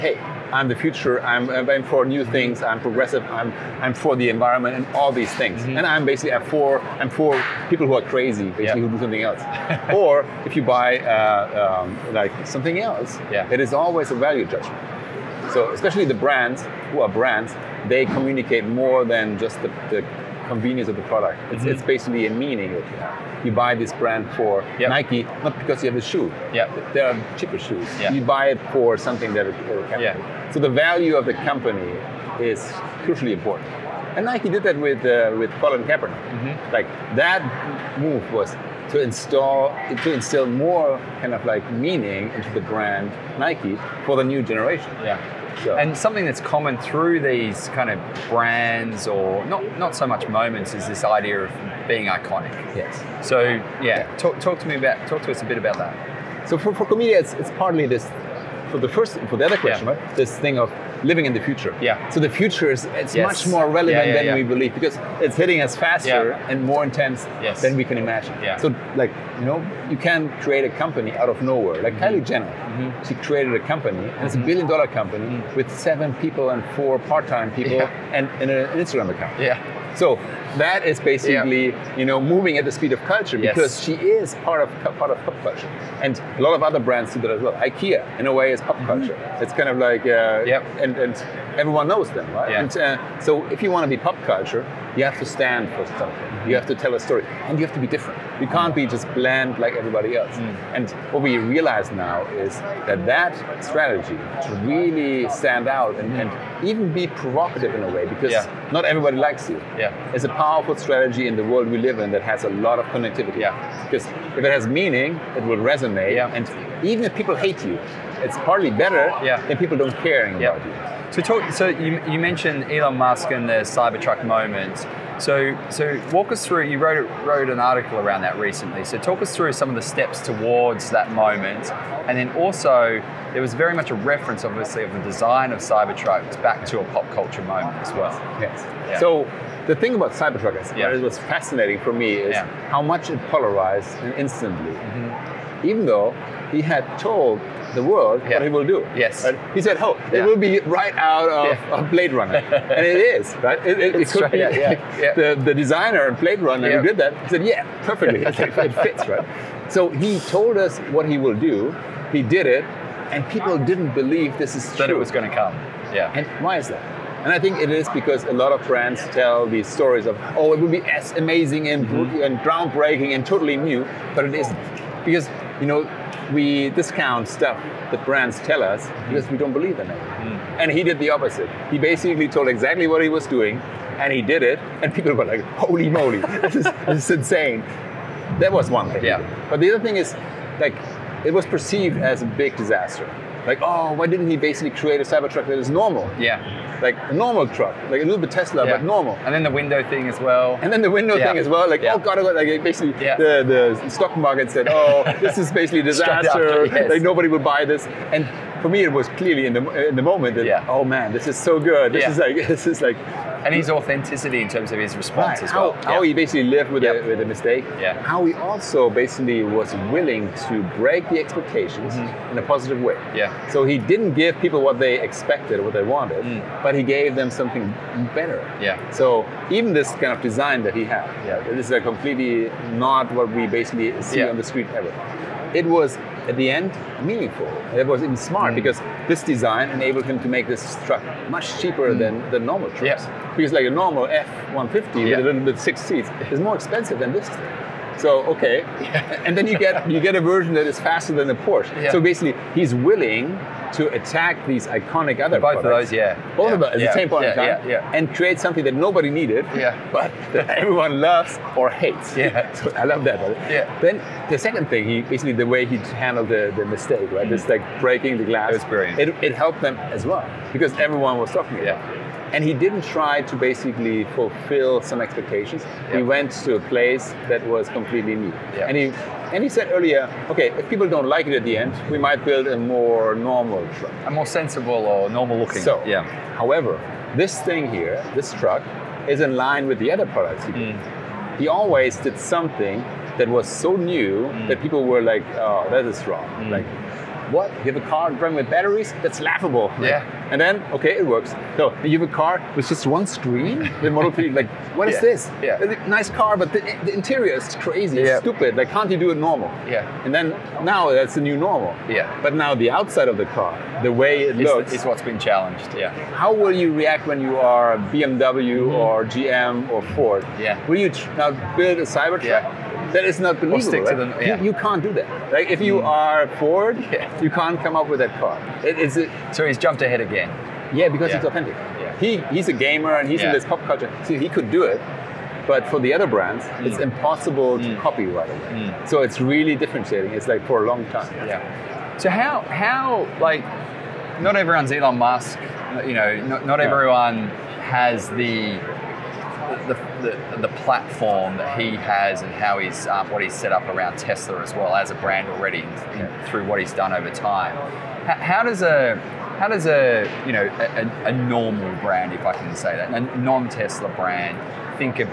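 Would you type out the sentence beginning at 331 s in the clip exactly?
He he's a gamer and he's in this pop culture.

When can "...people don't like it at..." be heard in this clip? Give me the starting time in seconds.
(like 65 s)
280 s.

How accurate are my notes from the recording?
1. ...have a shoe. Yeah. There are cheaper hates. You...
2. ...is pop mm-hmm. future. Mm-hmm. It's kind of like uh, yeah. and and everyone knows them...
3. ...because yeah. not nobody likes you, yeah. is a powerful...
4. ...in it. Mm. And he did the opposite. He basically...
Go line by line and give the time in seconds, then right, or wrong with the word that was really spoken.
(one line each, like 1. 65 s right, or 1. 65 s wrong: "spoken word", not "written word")
1. 25 s wrong: "shoes", not "hates"
2. 88 s wrong: "culture", not "future"
3. 108 s wrong: "everybody", not "nobody"
4. 179 s right.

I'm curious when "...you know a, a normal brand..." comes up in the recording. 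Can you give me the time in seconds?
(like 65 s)
360 s.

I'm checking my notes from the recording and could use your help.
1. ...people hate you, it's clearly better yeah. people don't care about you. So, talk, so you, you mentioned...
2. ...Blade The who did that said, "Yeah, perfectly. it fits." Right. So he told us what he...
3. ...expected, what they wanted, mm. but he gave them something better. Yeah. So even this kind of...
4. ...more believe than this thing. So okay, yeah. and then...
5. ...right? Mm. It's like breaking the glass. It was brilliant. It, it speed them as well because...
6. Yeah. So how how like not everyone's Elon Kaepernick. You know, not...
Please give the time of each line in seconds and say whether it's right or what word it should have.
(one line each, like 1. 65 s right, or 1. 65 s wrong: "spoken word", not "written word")
1. 117 s wrong: "hardly", not "clearly"
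2. 156 s wrong: "Runner", not "The"
3. 225 s right
4. 246 s wrong: "expensive", not "believe"
5. 267 s wrong: "helped", not "speed"
6. 341 s wrong: "Musk", not "Kaepernick".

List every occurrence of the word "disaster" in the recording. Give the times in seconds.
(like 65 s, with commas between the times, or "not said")
192 s, 205 s.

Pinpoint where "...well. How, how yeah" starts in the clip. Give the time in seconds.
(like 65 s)
215 s.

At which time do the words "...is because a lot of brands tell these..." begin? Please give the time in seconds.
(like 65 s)
167 s.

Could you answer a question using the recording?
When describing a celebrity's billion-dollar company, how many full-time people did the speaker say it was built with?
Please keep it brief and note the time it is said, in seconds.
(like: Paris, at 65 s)
7, at 75 s.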